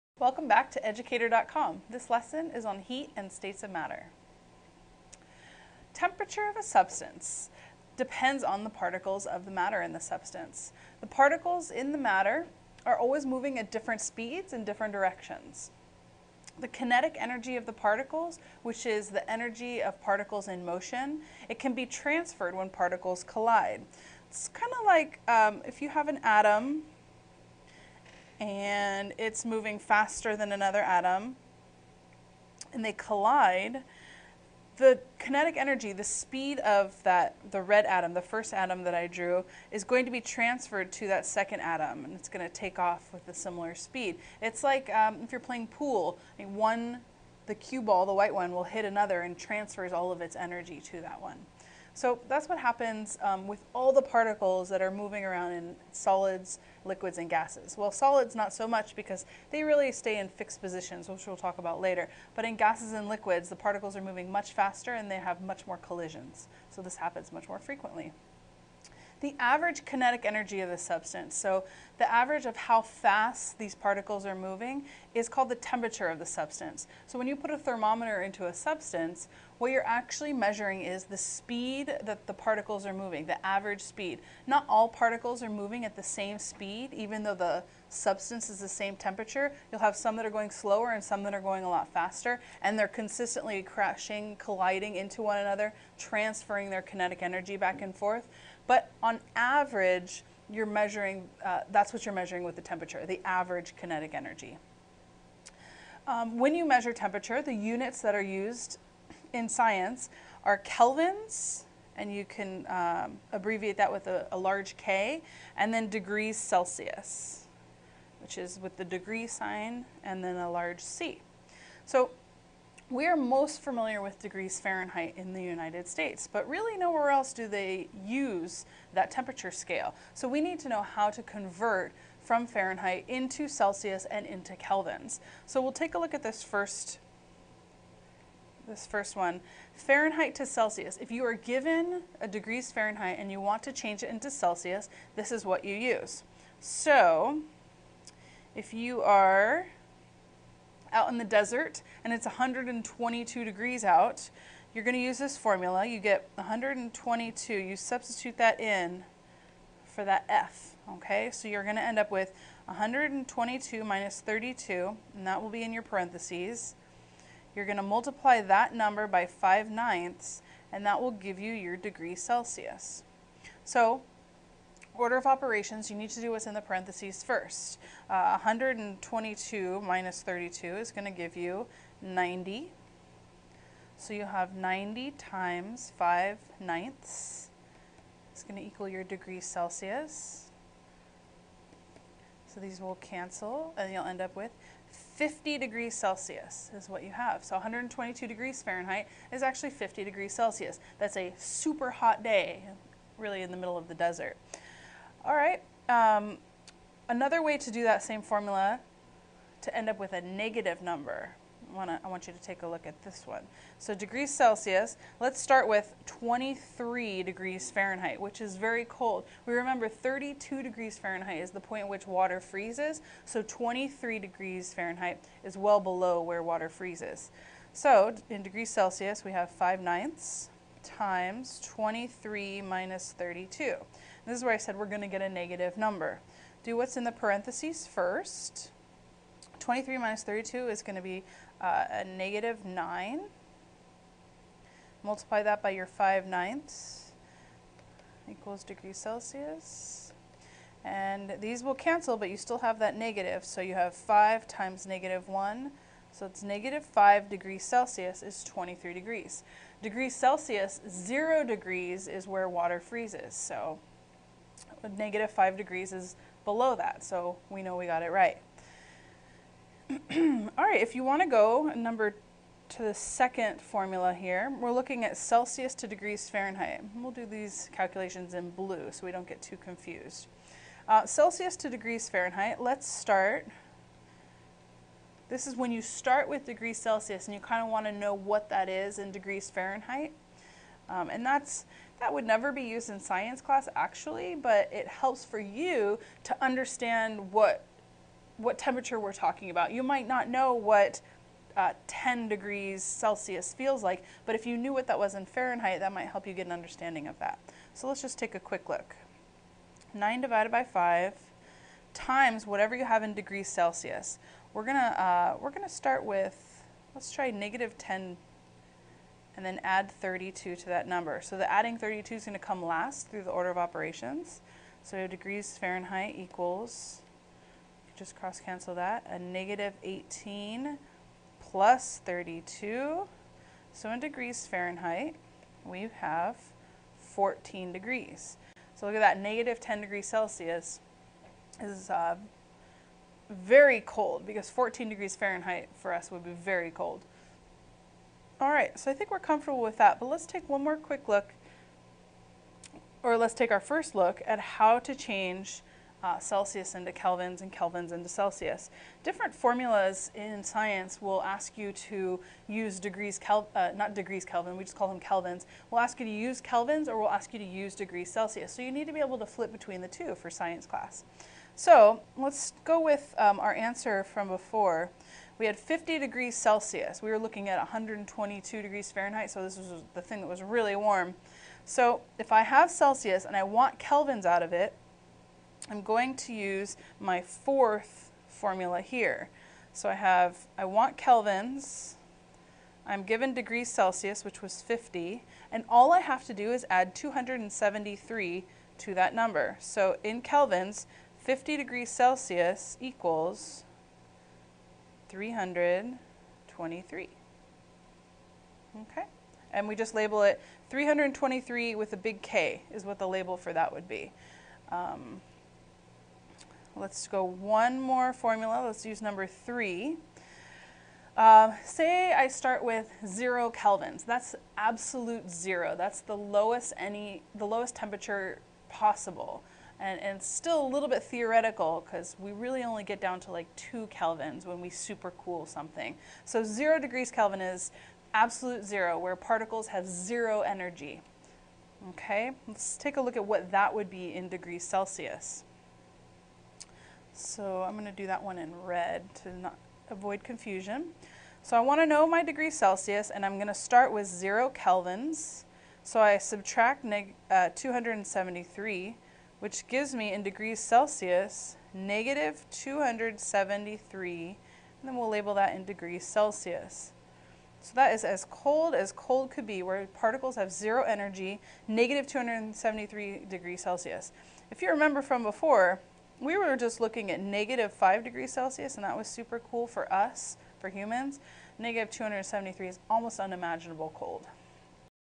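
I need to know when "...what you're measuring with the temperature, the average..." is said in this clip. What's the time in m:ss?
1:41.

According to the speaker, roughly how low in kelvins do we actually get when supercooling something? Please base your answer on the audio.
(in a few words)
2 kelvins.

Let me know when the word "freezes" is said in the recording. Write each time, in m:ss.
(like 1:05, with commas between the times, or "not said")
3:42, 3:46, 4:22.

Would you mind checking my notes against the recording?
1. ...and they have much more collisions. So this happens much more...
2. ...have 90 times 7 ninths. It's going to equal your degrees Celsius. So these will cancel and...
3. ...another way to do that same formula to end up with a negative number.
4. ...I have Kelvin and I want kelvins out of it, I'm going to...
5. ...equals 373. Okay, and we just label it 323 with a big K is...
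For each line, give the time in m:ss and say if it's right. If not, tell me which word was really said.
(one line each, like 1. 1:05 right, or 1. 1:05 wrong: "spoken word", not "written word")
1. 1:04 right
2. 3:04 wrong: "5", not "7"
3. 3:27 right
4. 6:22 wrong: "Celsius", not "Kelvin"
5. 6:42 wrong: "323", not "373".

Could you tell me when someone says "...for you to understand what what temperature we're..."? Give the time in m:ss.
4:55.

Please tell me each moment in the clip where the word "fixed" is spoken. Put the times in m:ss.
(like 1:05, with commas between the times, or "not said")
1:00.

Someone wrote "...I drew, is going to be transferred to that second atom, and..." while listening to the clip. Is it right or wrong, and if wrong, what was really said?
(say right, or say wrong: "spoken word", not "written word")
right.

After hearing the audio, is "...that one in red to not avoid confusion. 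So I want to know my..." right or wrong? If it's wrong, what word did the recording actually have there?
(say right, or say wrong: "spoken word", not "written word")
right.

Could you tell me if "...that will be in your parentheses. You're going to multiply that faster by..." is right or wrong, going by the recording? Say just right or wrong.
wrong.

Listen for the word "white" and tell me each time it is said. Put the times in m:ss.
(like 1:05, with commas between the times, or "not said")
0:48.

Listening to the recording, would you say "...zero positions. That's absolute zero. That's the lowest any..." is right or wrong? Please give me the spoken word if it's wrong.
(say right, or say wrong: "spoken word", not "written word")
wrong: "kelvins", not "positions".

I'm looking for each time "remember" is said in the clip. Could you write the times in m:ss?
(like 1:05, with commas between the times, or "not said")
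3:39, 7:54.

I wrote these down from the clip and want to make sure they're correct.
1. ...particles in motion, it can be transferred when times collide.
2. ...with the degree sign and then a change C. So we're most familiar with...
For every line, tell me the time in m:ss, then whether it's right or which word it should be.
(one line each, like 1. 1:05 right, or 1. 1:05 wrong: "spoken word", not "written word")
1. 0:20 wrong: "particles", not "times"
2. 1:58 wrong: "large", not "change".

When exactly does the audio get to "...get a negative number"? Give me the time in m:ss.
3:55.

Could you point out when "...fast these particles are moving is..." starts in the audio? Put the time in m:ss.
1:12.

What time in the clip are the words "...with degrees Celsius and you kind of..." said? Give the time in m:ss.
4:46.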